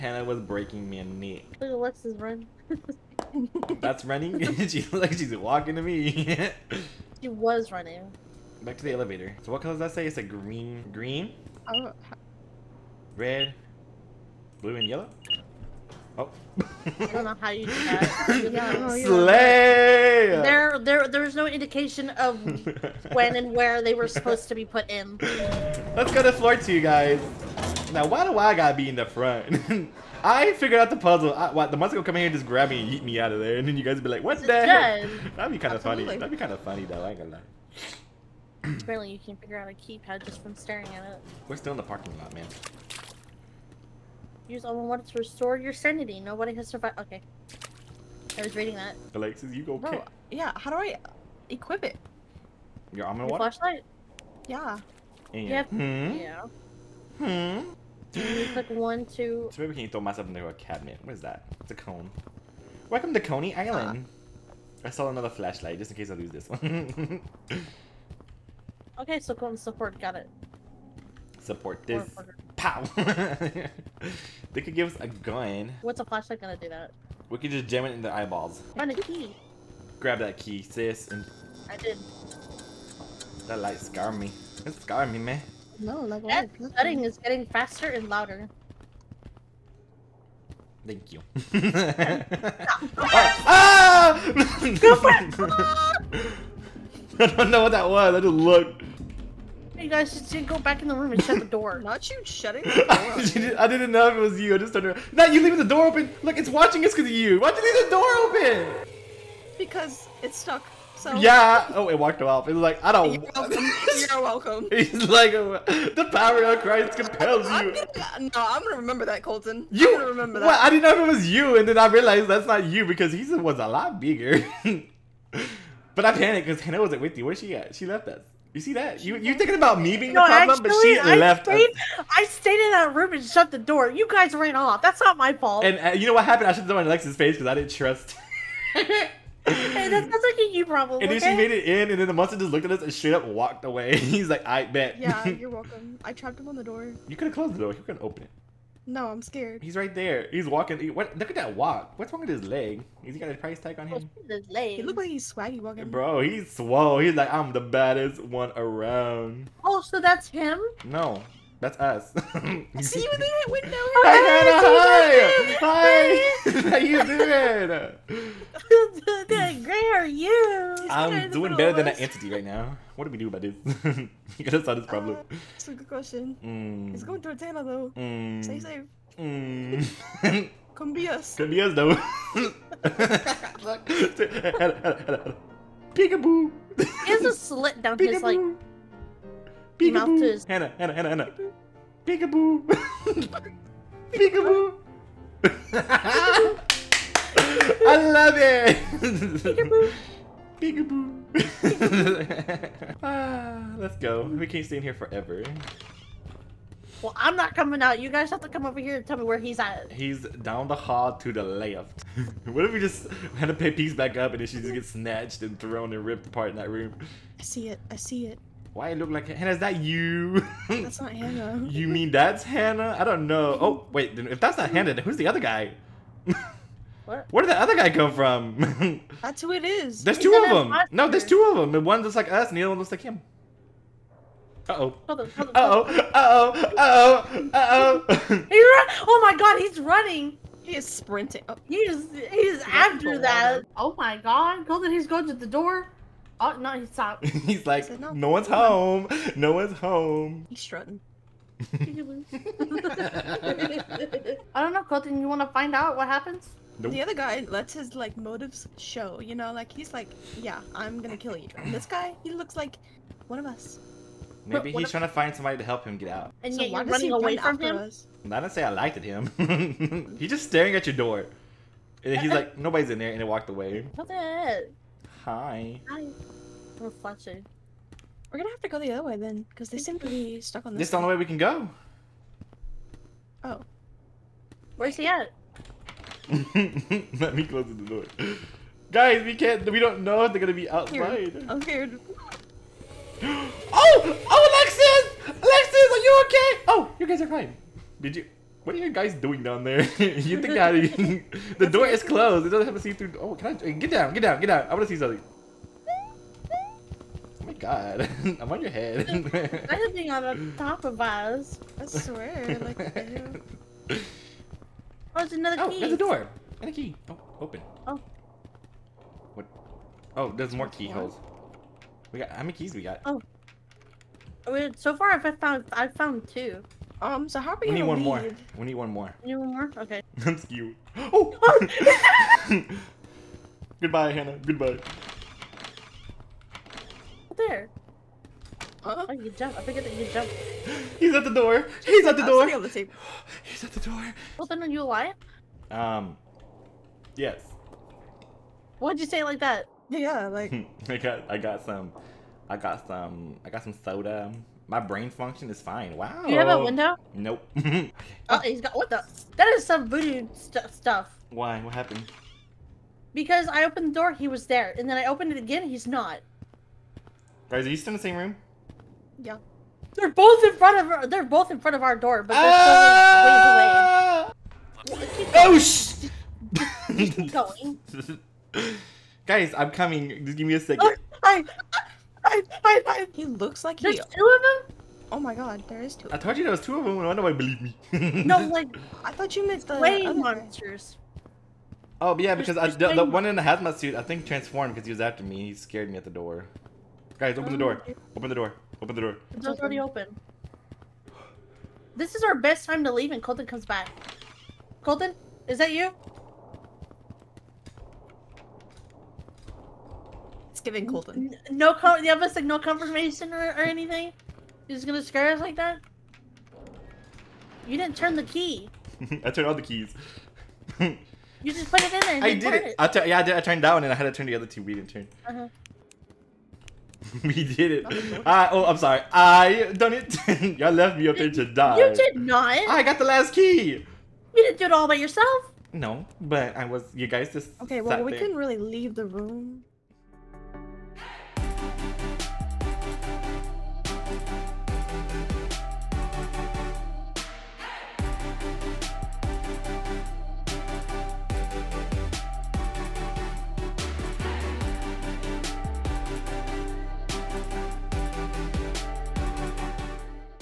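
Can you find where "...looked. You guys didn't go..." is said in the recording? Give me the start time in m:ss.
1:38.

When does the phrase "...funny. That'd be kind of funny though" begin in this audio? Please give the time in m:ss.
0:35.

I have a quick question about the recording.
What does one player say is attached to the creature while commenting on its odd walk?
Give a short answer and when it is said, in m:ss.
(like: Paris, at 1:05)
A price tag, at 2:33.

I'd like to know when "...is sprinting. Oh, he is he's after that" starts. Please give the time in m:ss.
4:00.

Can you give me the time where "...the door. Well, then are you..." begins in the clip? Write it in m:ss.
5:43.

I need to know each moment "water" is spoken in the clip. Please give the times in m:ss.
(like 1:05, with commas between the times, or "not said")
0:44, 0:53.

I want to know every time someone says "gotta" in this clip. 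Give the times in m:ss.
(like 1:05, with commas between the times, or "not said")
0:28, 2:54.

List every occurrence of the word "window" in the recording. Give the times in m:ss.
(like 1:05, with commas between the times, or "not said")
2:43, 5:56.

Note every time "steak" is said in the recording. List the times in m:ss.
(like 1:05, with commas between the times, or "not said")
not said.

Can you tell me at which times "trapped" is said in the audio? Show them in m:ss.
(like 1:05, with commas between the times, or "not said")
2:26.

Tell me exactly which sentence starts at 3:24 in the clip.
We can't stay in here forever.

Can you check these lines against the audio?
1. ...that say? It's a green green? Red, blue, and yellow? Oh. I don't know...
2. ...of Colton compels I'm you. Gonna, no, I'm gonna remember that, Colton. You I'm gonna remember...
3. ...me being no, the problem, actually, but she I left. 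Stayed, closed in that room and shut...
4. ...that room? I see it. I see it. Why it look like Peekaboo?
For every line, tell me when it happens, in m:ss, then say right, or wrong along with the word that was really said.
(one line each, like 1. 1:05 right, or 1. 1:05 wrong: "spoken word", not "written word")
1. 0:09 right
2. 1:56 wrong: "Christ", not "Colton"
3. 2:09 wrong: "stayed", not "closed"
4. 3:36 wrong: "Hannah", not "Peekaboo".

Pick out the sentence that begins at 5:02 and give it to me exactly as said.
It doesn't have to see through.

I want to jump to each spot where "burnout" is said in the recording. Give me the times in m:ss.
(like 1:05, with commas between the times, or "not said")
not said.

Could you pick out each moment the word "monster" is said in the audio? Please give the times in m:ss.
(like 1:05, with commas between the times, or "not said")
0:31, 2:22, 6:30.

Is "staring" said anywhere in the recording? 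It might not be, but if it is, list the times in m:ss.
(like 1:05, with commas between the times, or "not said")
0:40, 4:30.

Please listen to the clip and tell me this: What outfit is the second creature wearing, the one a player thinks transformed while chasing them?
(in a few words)
Hazmat suit.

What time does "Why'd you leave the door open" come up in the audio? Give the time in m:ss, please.
1:47.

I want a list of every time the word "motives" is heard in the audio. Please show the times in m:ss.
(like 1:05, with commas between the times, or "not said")
4:18.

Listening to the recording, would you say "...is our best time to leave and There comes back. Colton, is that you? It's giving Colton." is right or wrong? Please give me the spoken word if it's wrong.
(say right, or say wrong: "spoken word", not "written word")
wrong: "Colton", not "There".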